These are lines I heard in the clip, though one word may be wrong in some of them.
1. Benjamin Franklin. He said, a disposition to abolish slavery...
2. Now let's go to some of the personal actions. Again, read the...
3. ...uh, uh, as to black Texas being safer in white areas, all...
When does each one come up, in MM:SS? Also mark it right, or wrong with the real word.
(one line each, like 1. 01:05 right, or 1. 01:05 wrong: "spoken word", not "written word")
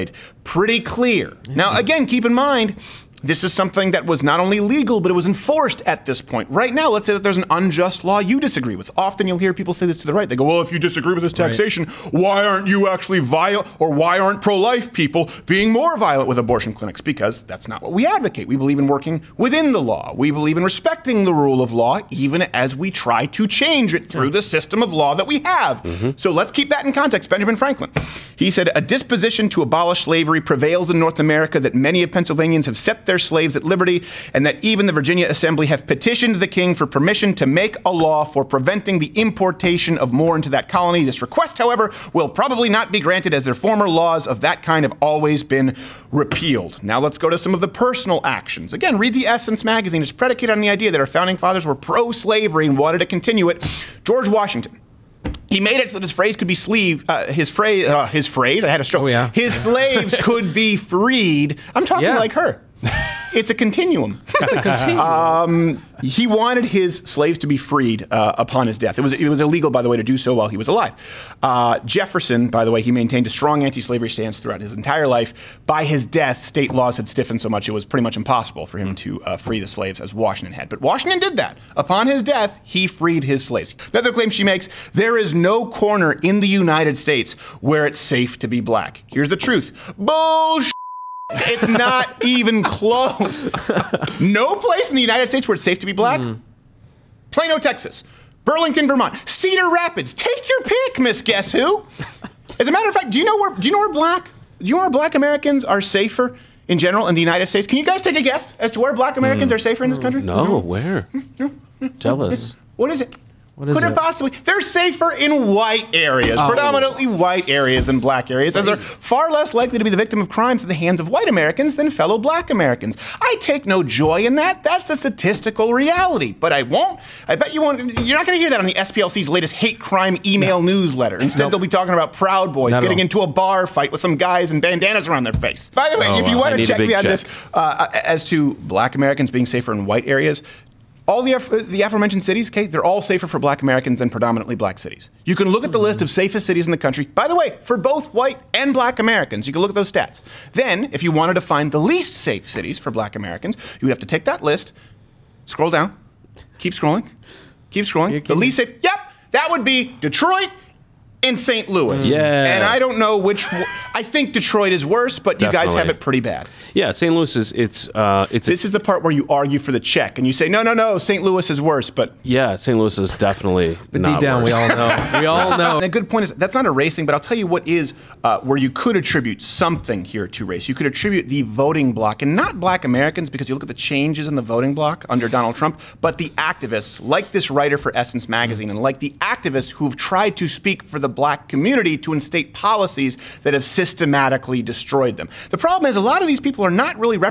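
1. 00:27 right
2. 00:46 right
3. 02:17 wrong: "Americans", not "Texas".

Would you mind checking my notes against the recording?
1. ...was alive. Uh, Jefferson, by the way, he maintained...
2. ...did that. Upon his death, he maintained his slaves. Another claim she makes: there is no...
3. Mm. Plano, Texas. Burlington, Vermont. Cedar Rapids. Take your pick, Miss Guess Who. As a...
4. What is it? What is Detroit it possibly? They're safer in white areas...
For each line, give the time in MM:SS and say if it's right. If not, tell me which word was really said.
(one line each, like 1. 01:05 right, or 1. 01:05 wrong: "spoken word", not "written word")
1. 01:10 right
2. 01:21 wrong: "freed", not "maintained"
3. 01:36 right
4. 01:52 wrong: "Could", not "Detroit".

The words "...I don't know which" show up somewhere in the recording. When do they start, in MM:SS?
02:42.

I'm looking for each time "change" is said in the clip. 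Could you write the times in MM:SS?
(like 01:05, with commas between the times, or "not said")
00:23, 03:03.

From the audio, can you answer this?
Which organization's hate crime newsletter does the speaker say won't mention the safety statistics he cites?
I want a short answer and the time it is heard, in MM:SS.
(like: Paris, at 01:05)
SPLC, at 02:08.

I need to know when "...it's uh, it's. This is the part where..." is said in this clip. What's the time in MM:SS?
02:47.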